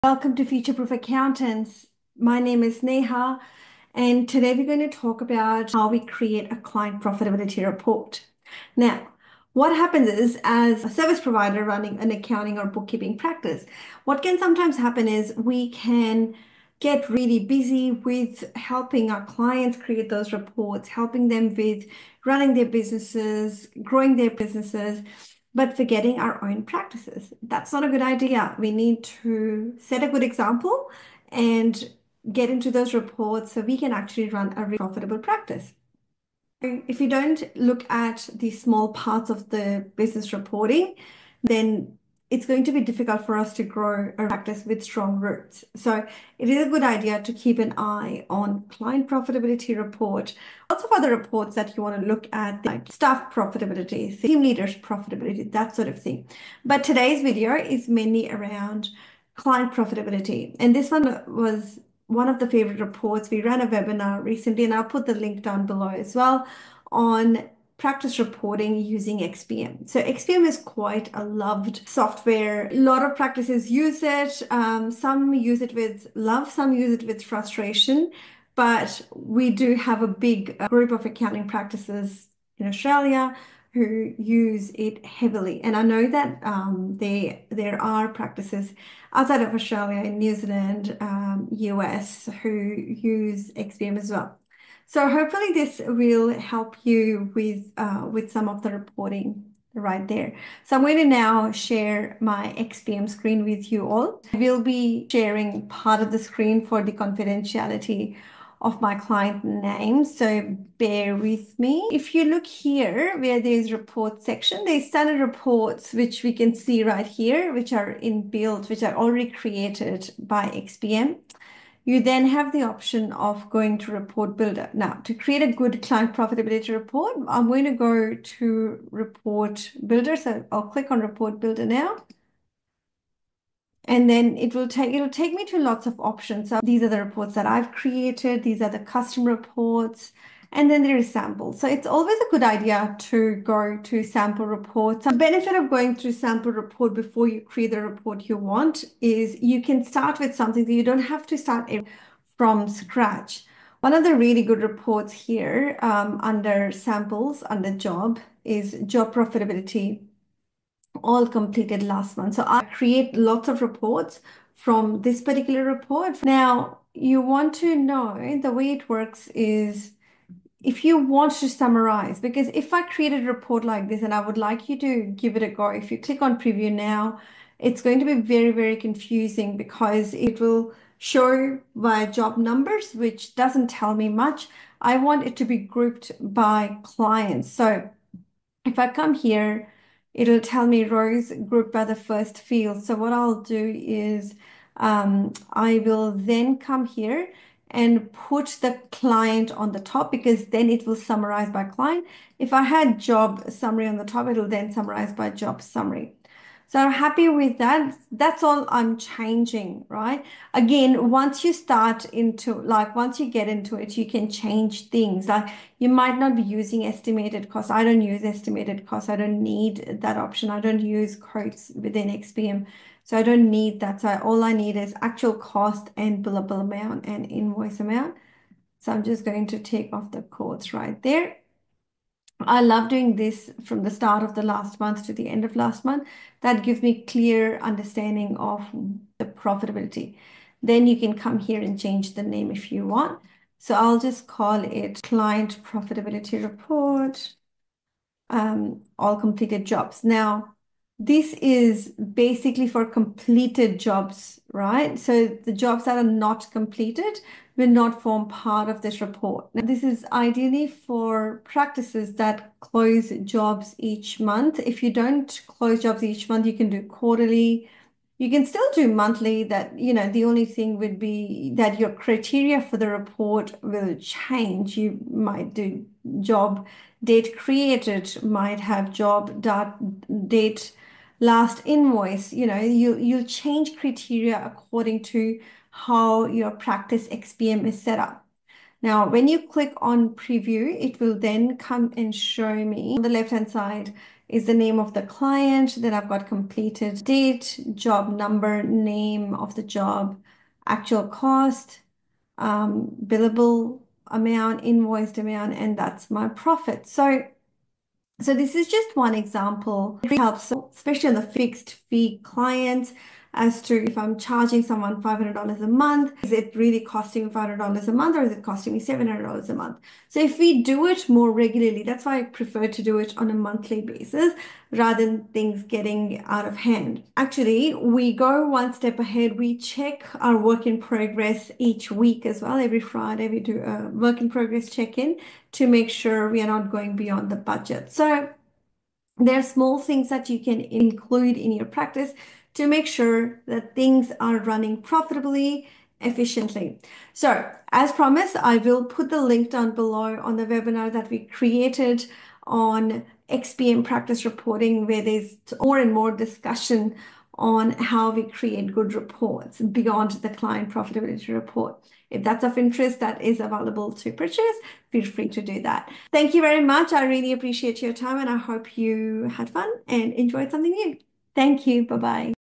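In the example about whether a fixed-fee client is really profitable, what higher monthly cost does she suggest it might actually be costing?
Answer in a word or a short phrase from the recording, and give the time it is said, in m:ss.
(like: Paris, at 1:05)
$700, at 5:18.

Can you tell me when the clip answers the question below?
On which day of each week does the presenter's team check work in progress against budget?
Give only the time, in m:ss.
5:32.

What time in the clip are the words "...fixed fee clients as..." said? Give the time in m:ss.
5:11.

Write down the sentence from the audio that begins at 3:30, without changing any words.
Again, once you start into like once you get into it, you can change things.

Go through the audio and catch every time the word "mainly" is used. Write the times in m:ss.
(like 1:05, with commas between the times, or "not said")
0:57.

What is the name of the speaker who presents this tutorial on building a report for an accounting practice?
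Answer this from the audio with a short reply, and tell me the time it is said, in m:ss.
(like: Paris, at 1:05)
Neha, at 0:02.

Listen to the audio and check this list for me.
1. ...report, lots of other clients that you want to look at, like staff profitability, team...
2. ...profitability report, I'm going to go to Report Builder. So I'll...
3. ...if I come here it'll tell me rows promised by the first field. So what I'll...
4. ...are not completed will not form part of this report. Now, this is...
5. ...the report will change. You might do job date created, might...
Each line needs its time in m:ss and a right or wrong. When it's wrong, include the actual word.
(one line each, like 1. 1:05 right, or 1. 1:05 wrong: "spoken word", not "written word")
1. 0:49 wrong: "reports", not "clients"
2. 2:06 right
3. 3:08 wrong: "grouped", not "promised"
4. 4:15 right
5. 4:32 right.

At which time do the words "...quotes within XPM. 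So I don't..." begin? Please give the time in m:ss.
3:41.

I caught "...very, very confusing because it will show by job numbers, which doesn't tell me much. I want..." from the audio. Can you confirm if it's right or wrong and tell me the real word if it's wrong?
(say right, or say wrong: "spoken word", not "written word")
right.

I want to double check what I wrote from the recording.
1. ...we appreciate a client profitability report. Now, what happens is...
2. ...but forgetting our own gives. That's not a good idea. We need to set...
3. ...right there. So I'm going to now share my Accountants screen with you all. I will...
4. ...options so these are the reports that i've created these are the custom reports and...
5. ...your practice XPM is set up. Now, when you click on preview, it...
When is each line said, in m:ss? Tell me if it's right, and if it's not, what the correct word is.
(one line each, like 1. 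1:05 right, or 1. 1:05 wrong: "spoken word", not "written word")
1. 0:05 wrong: "create", not "appreciate"
2. 0:25 wrong: "practices", not "gives"
3. 1:39 wrong: "XPM", not "Accountants"
4. 2:15 right
5. 4:46 right.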